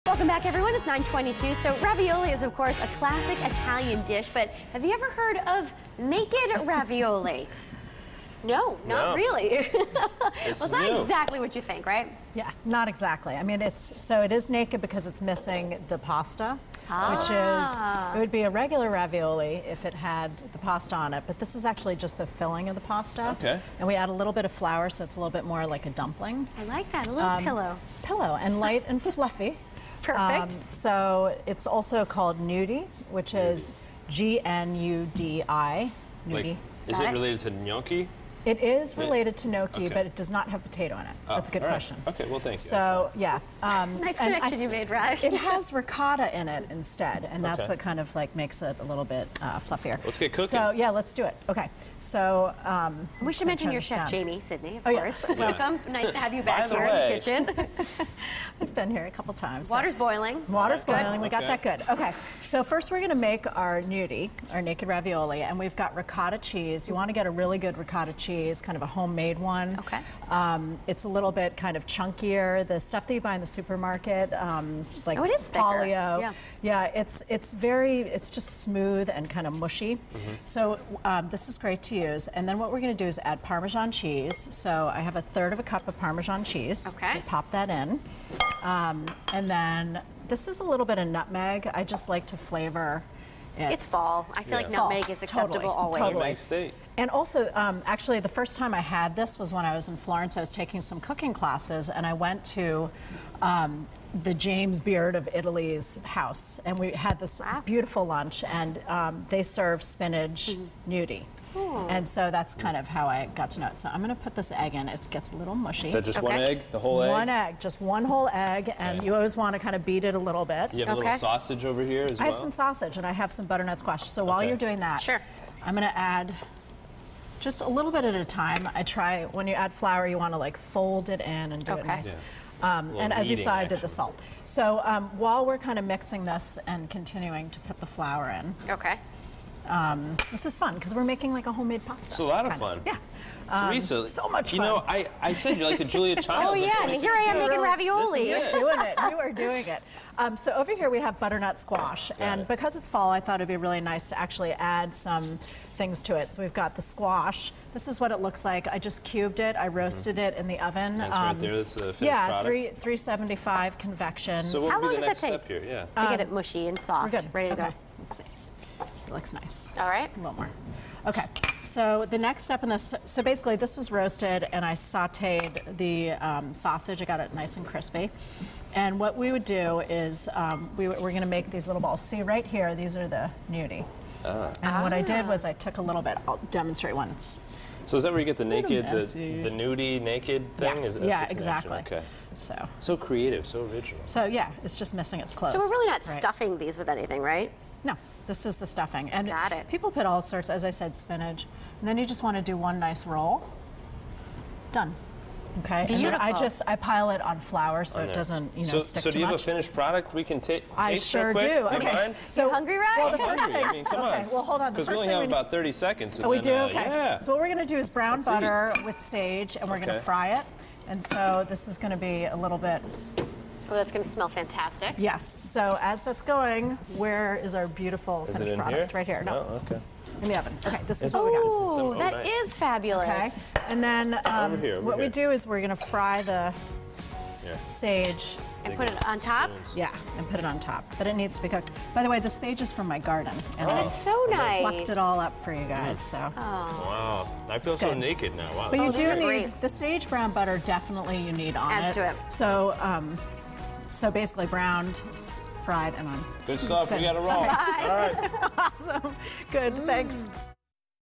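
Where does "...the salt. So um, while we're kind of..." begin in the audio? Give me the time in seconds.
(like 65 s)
133 s.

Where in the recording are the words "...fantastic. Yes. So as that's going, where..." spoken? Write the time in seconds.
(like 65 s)
224 s.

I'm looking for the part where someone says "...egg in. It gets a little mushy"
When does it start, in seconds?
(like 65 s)
114 s.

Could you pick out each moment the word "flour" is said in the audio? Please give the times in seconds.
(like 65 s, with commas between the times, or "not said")
24 s, 129 s, 137 s, 207 s.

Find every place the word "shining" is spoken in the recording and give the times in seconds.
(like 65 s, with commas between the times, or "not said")
not said.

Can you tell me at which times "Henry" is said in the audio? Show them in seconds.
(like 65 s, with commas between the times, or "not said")
not said.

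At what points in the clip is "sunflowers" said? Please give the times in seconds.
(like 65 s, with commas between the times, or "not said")
not said.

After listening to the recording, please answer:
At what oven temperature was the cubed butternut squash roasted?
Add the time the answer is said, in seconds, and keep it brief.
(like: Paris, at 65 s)
375, at 162 s.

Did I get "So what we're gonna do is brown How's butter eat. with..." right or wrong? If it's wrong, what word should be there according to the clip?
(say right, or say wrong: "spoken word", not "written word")
wrong: "Let", not "How".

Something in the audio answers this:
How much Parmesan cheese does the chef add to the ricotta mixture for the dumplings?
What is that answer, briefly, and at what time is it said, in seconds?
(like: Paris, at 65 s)
1/3 cup, at 85 s.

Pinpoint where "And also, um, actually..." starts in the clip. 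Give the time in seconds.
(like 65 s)
97 s.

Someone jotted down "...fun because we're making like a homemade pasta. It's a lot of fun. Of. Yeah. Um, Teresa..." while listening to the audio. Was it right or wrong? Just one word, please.
right.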